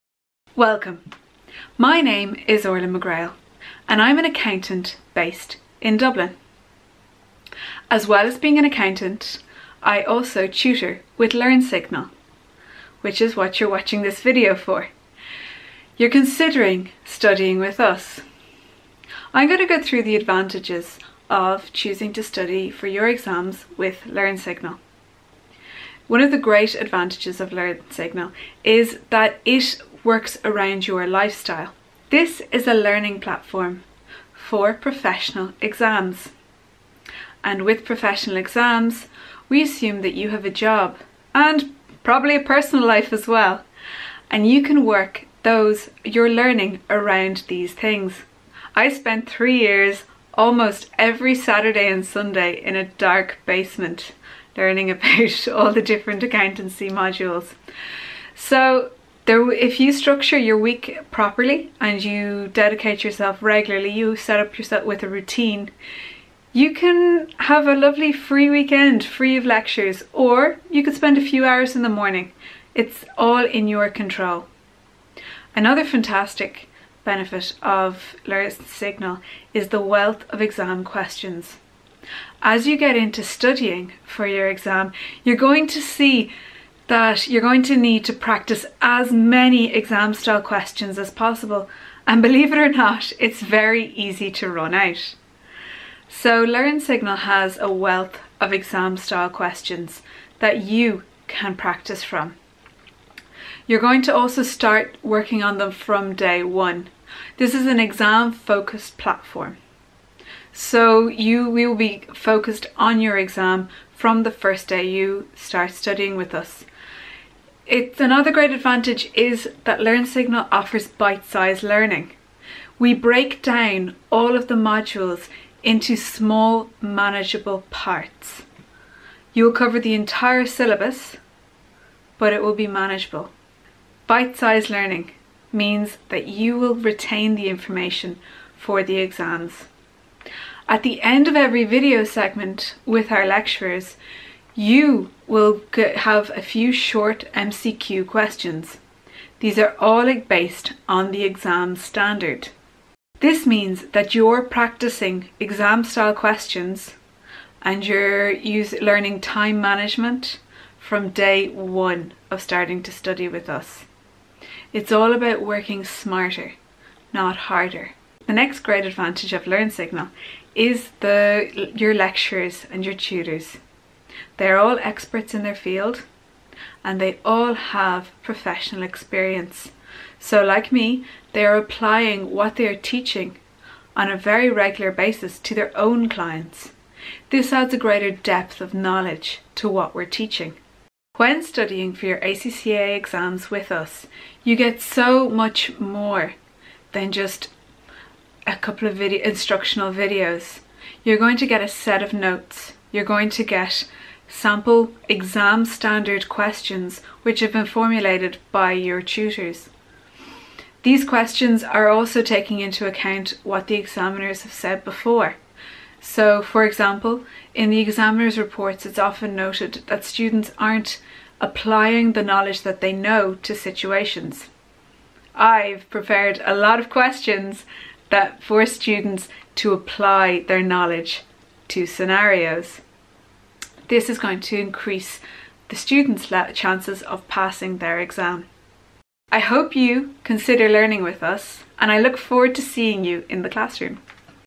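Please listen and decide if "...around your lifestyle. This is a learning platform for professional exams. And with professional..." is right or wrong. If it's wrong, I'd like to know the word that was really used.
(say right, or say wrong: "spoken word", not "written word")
right.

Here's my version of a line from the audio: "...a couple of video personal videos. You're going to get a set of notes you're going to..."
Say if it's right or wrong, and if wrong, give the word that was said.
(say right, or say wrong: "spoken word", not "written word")
wrong: "instructional", not "personal".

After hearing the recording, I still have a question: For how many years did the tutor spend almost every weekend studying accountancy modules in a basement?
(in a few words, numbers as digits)
3.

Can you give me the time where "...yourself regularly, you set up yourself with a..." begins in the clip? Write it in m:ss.
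1:03.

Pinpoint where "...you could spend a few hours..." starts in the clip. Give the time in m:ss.
1:10.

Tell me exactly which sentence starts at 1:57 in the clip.
It's another great advantage is that Learn Signal offers bite-sized learning.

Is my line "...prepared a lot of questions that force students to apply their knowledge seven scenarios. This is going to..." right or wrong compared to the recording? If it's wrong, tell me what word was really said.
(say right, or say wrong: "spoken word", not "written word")
wrong: "two", not "seven".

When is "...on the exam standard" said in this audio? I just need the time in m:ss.
2:30.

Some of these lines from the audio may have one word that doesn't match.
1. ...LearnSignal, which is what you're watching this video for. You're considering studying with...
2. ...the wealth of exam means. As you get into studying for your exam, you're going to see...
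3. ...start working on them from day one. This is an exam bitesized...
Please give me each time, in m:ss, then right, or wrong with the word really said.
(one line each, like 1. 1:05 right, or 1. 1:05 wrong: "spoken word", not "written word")
1. 0:11 right
2. 1:19 wrong: "questions", not "means"
3. 1:44 wrong: "focused", not "bitesized".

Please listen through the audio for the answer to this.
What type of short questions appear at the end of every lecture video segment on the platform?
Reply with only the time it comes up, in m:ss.
2:27.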